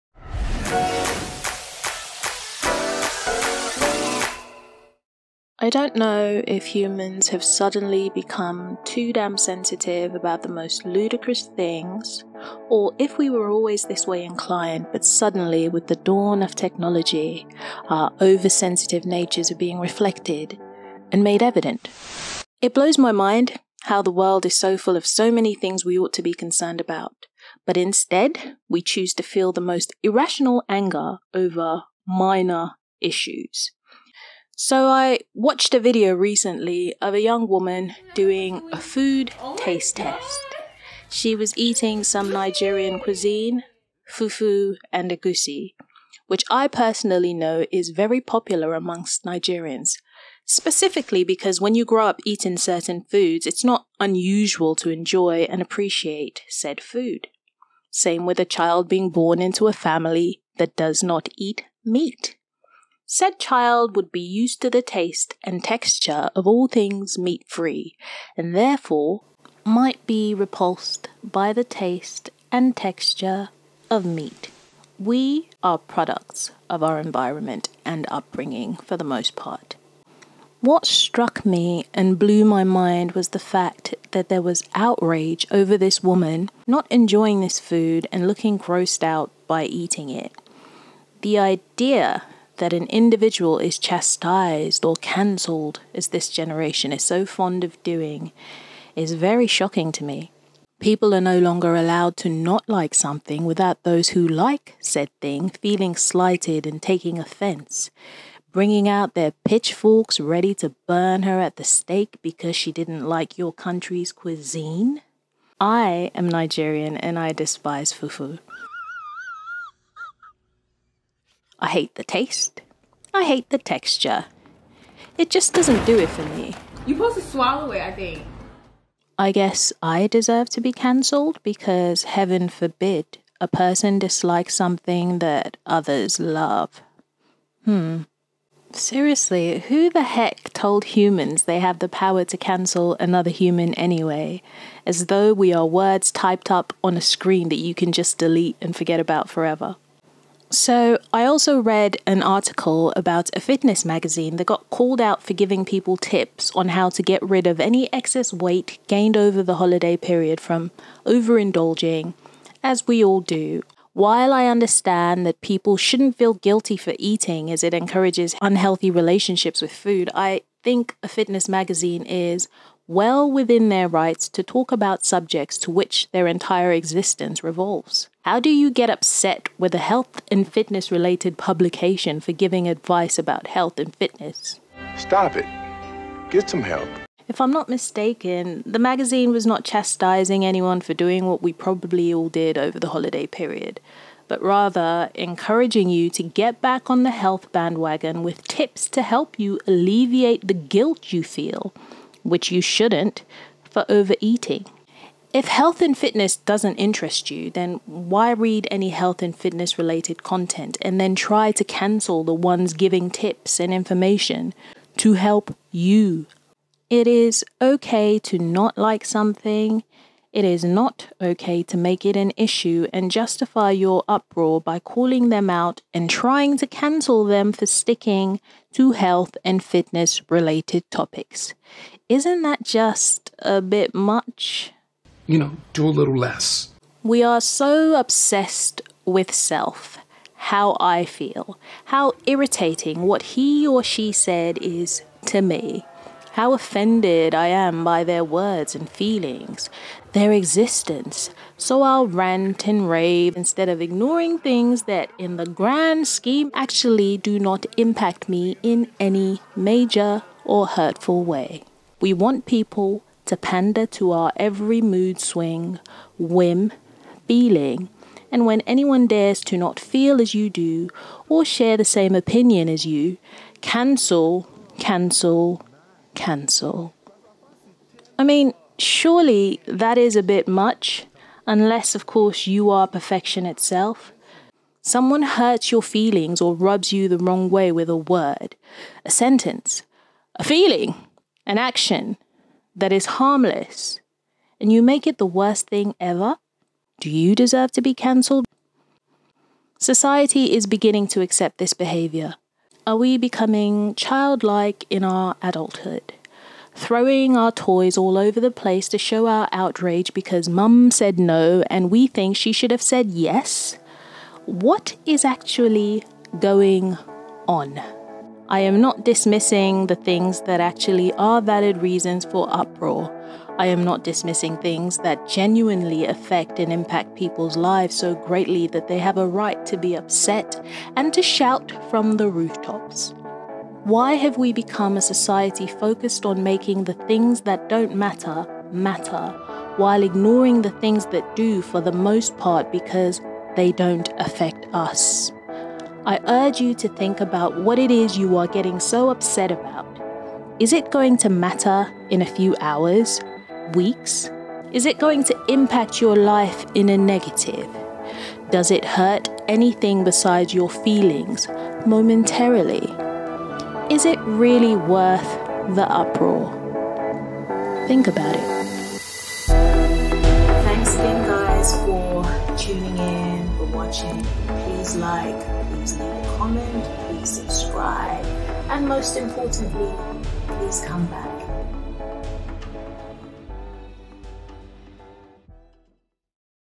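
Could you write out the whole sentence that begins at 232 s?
Isn't that just a bit much?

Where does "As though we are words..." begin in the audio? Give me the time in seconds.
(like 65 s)
144 s.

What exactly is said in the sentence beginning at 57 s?
Same with a child being born into a family that does not eat meat.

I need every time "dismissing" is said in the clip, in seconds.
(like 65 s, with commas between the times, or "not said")
319 s, 324 s.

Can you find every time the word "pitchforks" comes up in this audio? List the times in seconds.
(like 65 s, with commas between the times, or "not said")
109 s.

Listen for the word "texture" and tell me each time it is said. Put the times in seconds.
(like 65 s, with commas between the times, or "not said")
65 s, 72 s, 123 s.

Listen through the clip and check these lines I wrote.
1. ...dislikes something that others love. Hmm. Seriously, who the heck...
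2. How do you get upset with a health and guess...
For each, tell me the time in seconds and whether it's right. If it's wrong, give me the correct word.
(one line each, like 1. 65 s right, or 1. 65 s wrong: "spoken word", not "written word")
1. 133 s right
2. 178 s wrong: "fitness", not "guess".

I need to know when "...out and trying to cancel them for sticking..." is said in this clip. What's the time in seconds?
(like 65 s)
225 s.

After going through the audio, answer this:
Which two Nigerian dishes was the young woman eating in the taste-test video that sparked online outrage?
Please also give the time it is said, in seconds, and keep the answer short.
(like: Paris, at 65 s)
fufu and egusi, at 44 s.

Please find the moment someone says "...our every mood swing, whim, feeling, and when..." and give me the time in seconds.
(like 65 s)
264 s.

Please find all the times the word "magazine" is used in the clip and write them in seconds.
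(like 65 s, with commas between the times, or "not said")
153 s, 171 s, 188 s.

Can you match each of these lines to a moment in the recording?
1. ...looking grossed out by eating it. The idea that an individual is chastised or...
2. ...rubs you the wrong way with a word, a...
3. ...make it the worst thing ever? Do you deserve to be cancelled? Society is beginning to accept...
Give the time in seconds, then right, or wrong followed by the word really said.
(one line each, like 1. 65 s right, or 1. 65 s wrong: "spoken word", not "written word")
1. 88 s right
2. 286 s right
3. 294 s right.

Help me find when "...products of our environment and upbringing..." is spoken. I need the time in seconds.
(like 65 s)
75 s.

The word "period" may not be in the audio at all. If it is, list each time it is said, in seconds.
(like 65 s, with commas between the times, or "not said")
159 s, 193 s.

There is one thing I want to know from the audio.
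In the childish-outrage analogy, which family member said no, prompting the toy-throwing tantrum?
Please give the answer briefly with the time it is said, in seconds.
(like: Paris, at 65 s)
mum, at 310 s.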